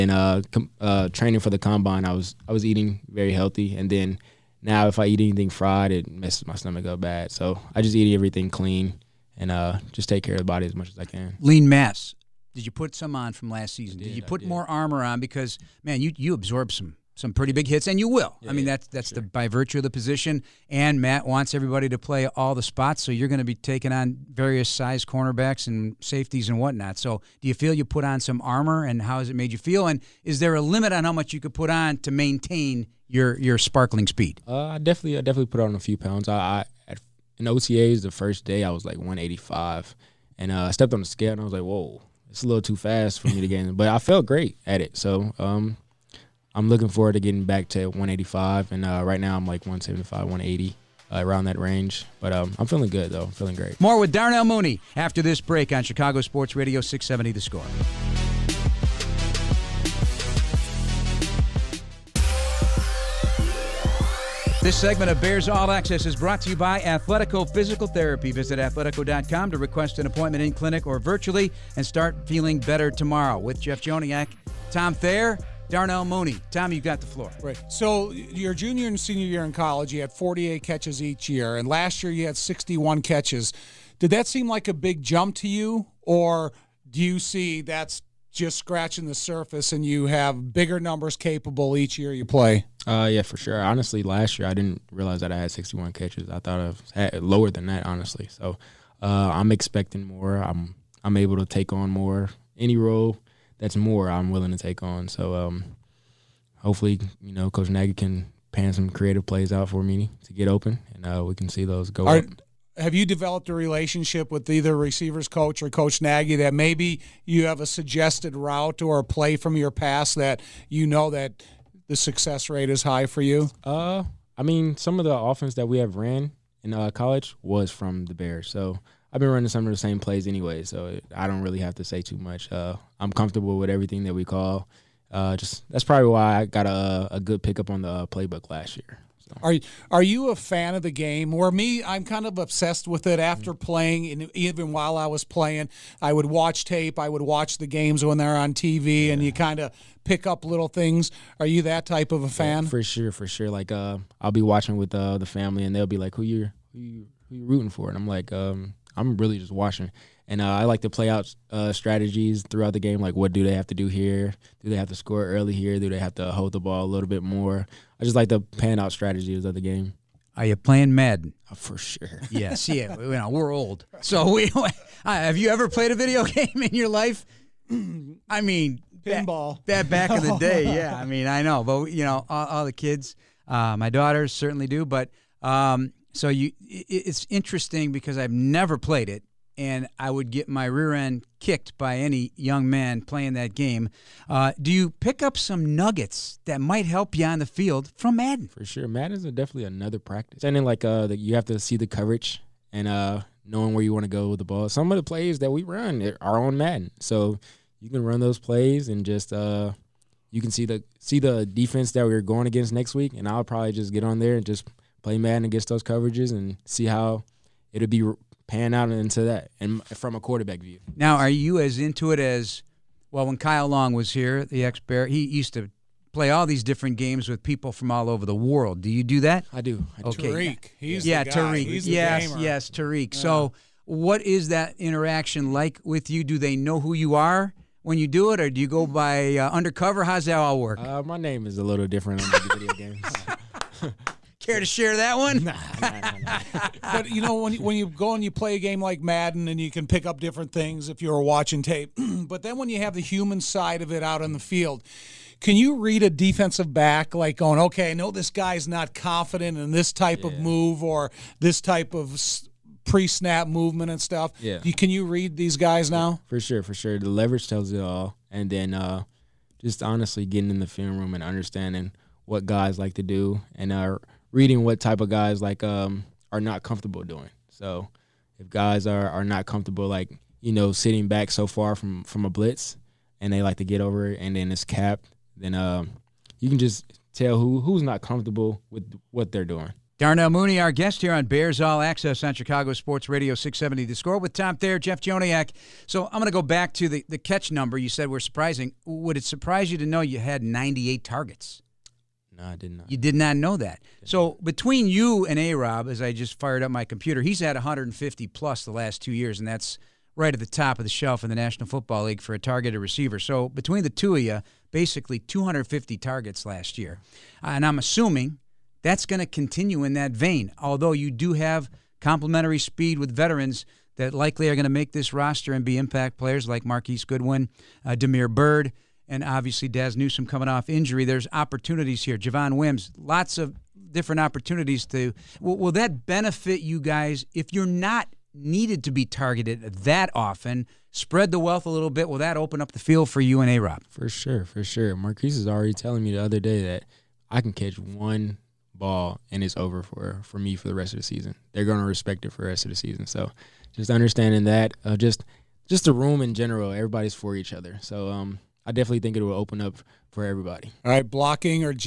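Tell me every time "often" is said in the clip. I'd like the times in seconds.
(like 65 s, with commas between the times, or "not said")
340 s.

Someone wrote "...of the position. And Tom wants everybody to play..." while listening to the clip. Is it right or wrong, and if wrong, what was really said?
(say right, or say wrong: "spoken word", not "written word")
wrong: "Matt", not "Tom".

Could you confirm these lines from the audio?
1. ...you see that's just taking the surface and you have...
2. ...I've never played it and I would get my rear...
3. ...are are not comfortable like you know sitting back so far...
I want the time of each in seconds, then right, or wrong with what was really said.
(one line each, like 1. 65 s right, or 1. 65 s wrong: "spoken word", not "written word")
1. 87 s wrong: "scratching", not "taking"
2. 188 s right
3. 278 s right.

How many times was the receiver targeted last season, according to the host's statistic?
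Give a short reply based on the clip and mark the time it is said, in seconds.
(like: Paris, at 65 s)
98, at 300 s.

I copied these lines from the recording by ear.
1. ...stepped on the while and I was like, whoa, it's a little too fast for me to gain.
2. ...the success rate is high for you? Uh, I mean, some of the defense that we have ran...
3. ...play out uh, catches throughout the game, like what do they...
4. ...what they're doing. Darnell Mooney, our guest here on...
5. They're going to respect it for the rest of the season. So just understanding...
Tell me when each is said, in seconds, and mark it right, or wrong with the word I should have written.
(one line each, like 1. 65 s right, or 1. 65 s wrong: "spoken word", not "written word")
1. 40 s wrong: "scale", not "while"
2. 121 s wrong: "offense", not "defense"
3. 160 s wrong: "strategies", not "catches"
4. 289 s right
5. 351 s right.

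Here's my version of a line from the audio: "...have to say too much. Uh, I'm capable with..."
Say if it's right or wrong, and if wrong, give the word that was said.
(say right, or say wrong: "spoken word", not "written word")
wrong: "comfortable", not "capable".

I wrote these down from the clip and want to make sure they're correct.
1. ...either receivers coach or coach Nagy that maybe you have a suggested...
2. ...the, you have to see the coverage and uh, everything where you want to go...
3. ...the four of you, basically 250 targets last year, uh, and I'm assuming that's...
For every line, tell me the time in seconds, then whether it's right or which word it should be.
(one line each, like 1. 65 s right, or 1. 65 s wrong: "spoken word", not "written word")
1. 114 s right
2. 201 s wrong: "knowing", not "everything"
3. 313 s wrong: "two", not "four".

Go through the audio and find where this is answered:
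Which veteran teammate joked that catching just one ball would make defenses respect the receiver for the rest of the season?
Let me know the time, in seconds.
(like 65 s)
326 s.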